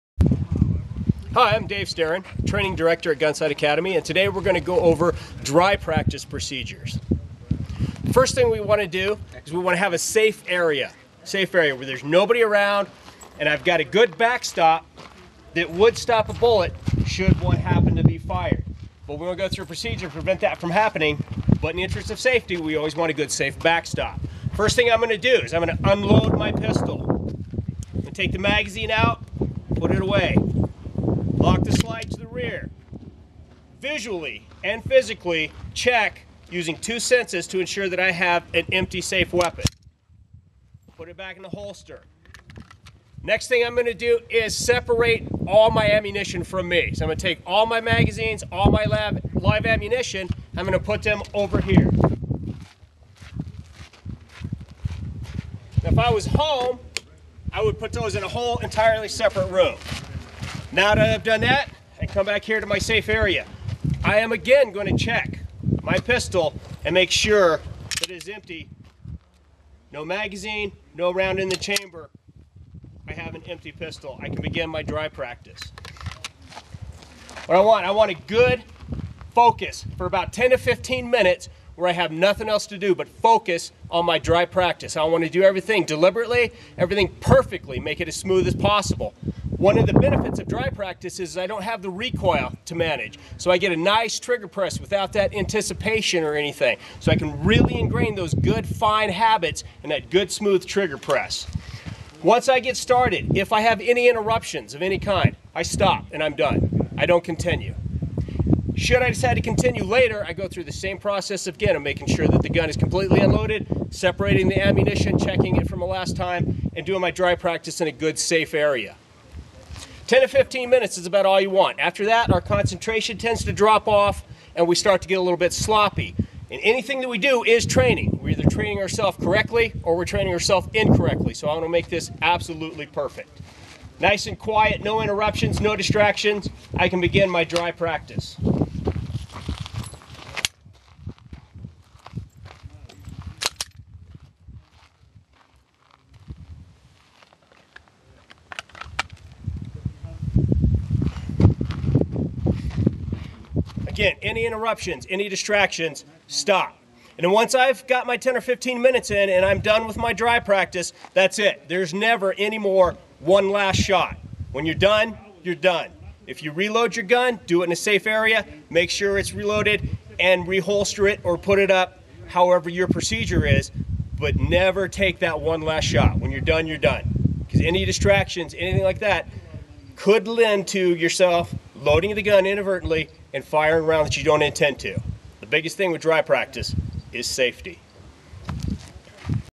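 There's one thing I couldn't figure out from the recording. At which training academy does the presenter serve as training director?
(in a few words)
Gunsite Academy.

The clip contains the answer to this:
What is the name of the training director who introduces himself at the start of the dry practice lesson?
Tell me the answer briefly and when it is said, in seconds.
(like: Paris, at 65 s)
Dave Starin, at 1 s.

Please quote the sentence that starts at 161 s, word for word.
There's never any more one last shot.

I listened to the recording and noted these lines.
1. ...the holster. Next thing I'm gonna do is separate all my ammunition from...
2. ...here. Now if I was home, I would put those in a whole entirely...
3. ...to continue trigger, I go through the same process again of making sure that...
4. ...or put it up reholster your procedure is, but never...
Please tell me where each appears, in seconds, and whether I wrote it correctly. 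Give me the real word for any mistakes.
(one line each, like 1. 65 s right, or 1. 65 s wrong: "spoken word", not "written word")
1. 41 s right
2. 51 s right
3. 109 s wrong: "later", not "trigger"
4. 171 s wrong: "however", not "reholster".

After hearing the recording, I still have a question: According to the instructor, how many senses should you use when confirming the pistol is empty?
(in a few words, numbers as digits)
2.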